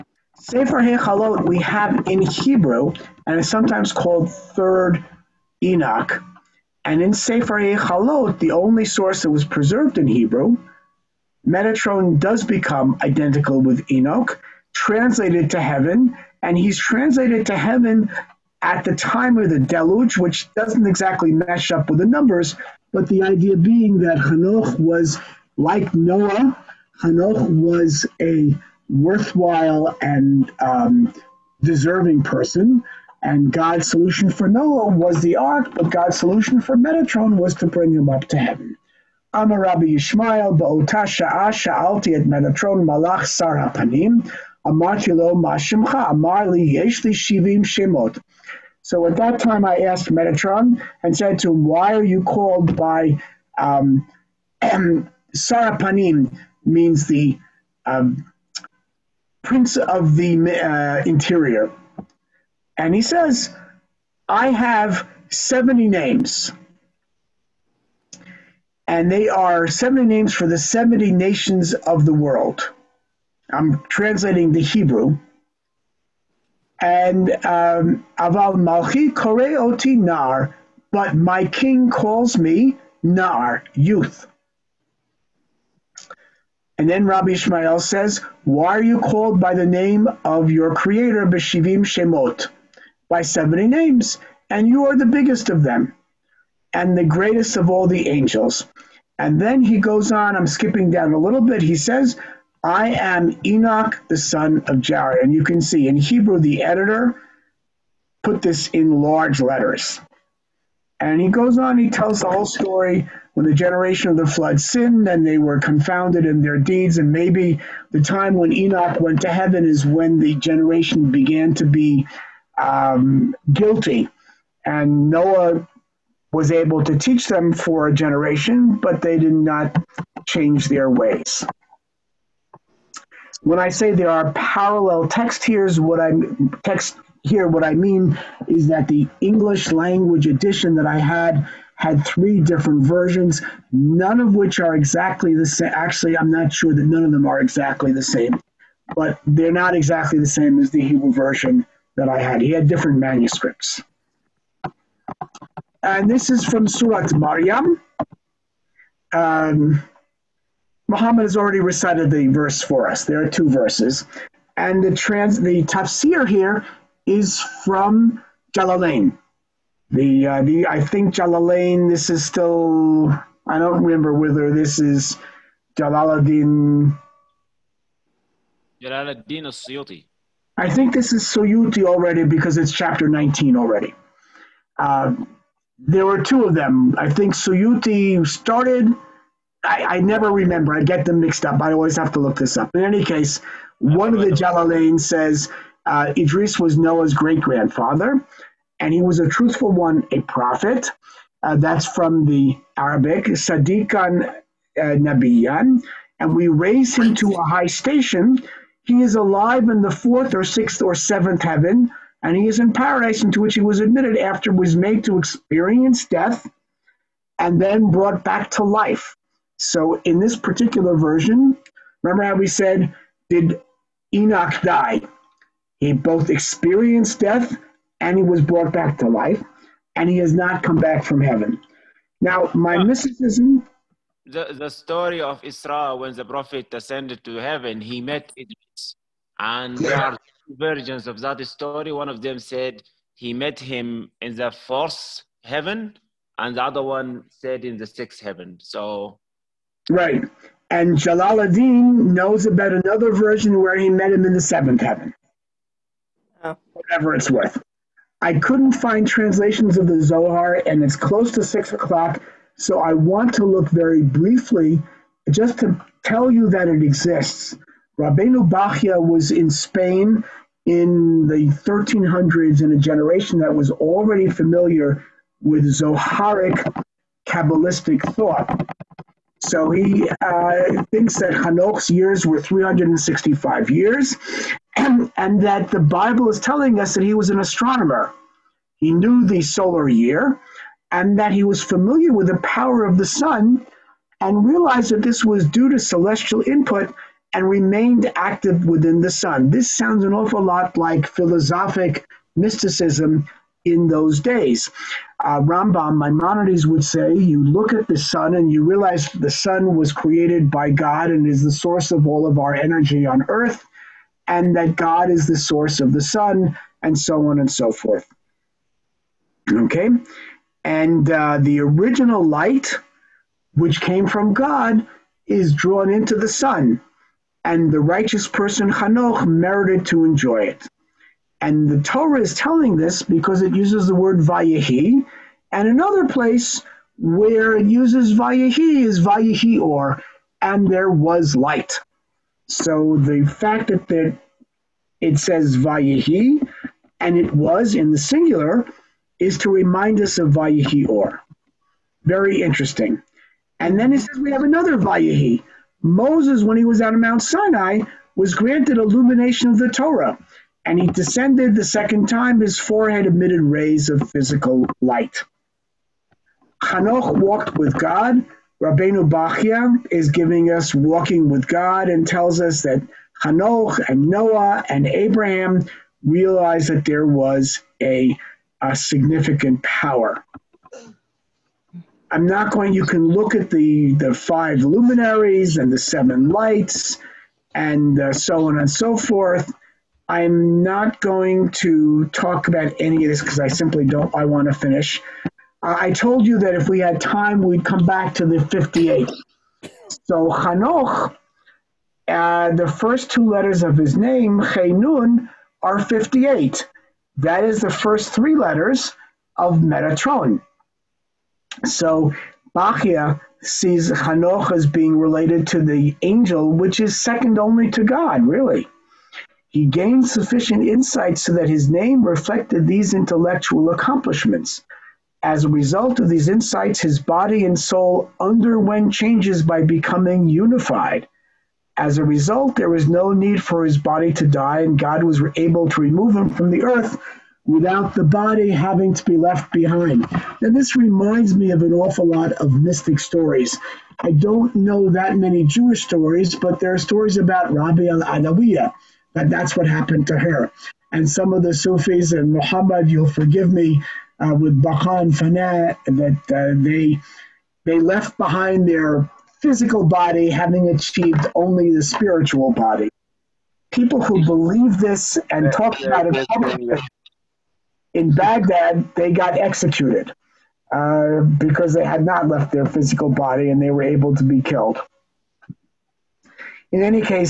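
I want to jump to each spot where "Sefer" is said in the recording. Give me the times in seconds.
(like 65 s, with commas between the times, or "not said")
0 s, 7 s.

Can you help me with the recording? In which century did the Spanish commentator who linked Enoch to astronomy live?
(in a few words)
1300s.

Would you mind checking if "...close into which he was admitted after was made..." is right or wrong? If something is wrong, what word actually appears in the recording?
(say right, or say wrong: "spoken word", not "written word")
wrong: "paradise", not "close".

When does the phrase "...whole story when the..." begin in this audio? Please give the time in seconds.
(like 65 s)
112 s.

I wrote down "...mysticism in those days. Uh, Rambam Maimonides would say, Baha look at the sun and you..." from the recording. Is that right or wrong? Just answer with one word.
wrong.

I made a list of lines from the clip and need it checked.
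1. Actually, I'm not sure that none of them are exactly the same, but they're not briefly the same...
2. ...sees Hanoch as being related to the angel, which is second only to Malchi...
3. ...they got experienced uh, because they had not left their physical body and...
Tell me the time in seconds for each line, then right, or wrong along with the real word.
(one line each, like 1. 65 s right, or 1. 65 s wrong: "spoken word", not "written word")
1. 145 s wrong: "exactly", not "briefly"
2. 413 s wrong: "God", not "Malchi"
3. 468 s wrong: "executed", not "experienced".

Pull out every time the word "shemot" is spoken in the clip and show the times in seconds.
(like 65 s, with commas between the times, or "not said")
47 s, 91 s.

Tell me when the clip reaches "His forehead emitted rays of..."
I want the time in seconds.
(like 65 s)
362 s.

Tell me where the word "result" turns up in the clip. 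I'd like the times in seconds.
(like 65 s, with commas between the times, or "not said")
425 s, 432 s.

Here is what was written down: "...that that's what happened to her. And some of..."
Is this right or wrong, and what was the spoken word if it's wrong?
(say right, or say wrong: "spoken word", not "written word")
right.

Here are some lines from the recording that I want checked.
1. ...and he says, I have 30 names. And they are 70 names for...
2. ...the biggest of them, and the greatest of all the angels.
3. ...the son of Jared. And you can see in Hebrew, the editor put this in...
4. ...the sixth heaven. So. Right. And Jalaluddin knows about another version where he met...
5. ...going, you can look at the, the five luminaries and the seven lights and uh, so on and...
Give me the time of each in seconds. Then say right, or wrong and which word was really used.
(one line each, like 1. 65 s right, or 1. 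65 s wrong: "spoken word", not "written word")
1. 62 s wrong: "70", not "30"
2. 94 s right
3. 104 s right
4. 247 s right
5. 382 s right.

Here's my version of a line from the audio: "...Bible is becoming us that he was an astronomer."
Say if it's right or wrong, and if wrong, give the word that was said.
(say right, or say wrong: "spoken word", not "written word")
wrong: "telling", not "becoming".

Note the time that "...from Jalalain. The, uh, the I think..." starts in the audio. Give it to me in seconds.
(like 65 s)
167 s.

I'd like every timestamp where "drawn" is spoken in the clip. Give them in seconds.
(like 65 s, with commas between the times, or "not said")
325 s.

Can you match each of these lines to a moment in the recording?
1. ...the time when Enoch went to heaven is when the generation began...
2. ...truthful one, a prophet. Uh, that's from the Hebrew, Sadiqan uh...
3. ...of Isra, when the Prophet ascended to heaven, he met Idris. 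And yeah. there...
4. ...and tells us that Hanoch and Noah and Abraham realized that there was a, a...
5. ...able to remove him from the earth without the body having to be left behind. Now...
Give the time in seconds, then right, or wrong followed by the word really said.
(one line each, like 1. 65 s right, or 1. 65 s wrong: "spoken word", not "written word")
1. 117 s right
2. 199 s wrong: "Arabic", not "Hebrew"
3. 235 s right
4. 371 s right
5. 435 s right.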